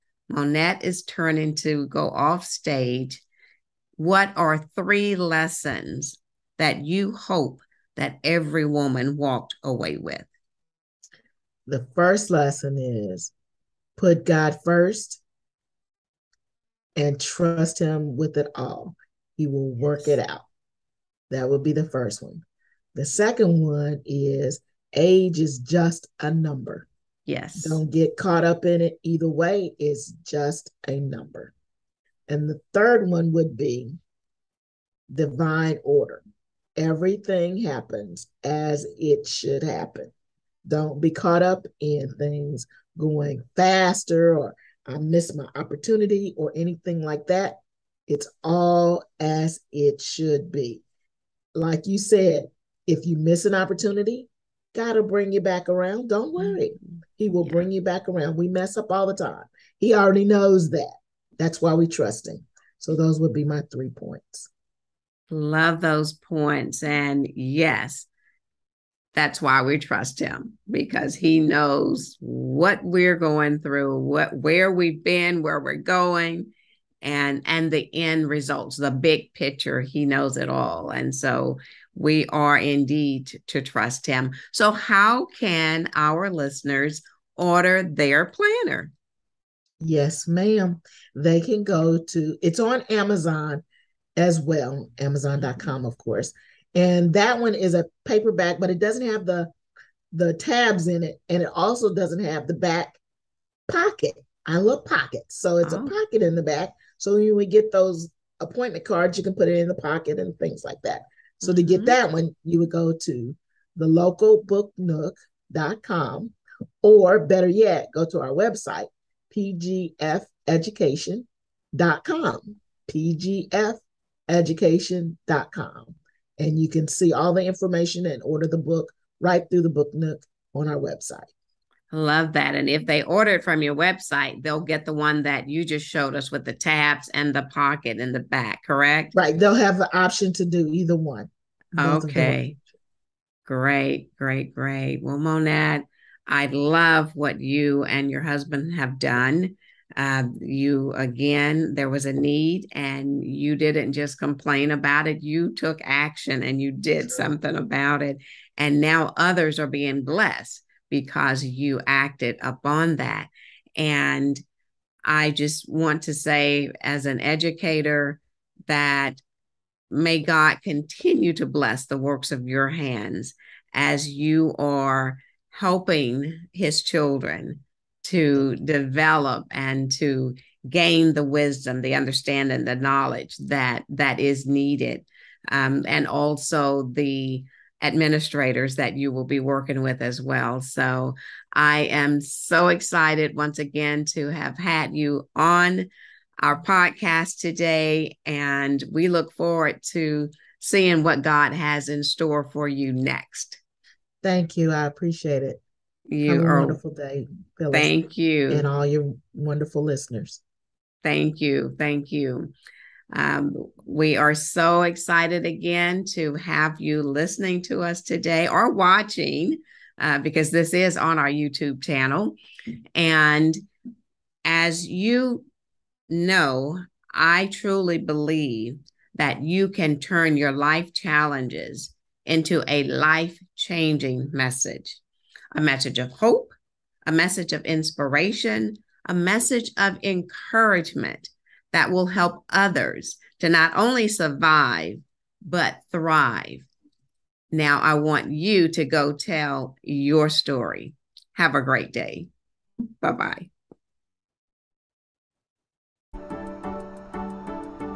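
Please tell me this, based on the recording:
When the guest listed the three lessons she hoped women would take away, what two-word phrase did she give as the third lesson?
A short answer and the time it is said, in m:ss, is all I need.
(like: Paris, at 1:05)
Divine order, at 0:35.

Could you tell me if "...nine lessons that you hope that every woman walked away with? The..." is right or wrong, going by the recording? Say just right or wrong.
wrong.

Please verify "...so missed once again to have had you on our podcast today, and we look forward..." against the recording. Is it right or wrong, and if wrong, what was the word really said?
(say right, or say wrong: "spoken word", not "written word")
wrong: "excited", not "missed".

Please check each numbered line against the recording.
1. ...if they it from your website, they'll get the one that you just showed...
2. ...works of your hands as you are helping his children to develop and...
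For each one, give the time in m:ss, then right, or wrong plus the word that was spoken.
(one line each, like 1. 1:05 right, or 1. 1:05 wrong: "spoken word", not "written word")
1. 2:12 right
2. 2:51 right.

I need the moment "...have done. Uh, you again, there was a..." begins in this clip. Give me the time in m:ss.
2:28.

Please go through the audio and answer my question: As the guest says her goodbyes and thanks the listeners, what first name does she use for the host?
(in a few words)
Phyllis.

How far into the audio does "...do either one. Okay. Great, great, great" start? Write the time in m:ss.
2:20.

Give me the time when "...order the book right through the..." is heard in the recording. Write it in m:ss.
2:08.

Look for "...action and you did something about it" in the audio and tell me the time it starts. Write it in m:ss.
2:35.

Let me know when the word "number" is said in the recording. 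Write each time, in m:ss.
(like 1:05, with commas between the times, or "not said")
0:26, 0:30.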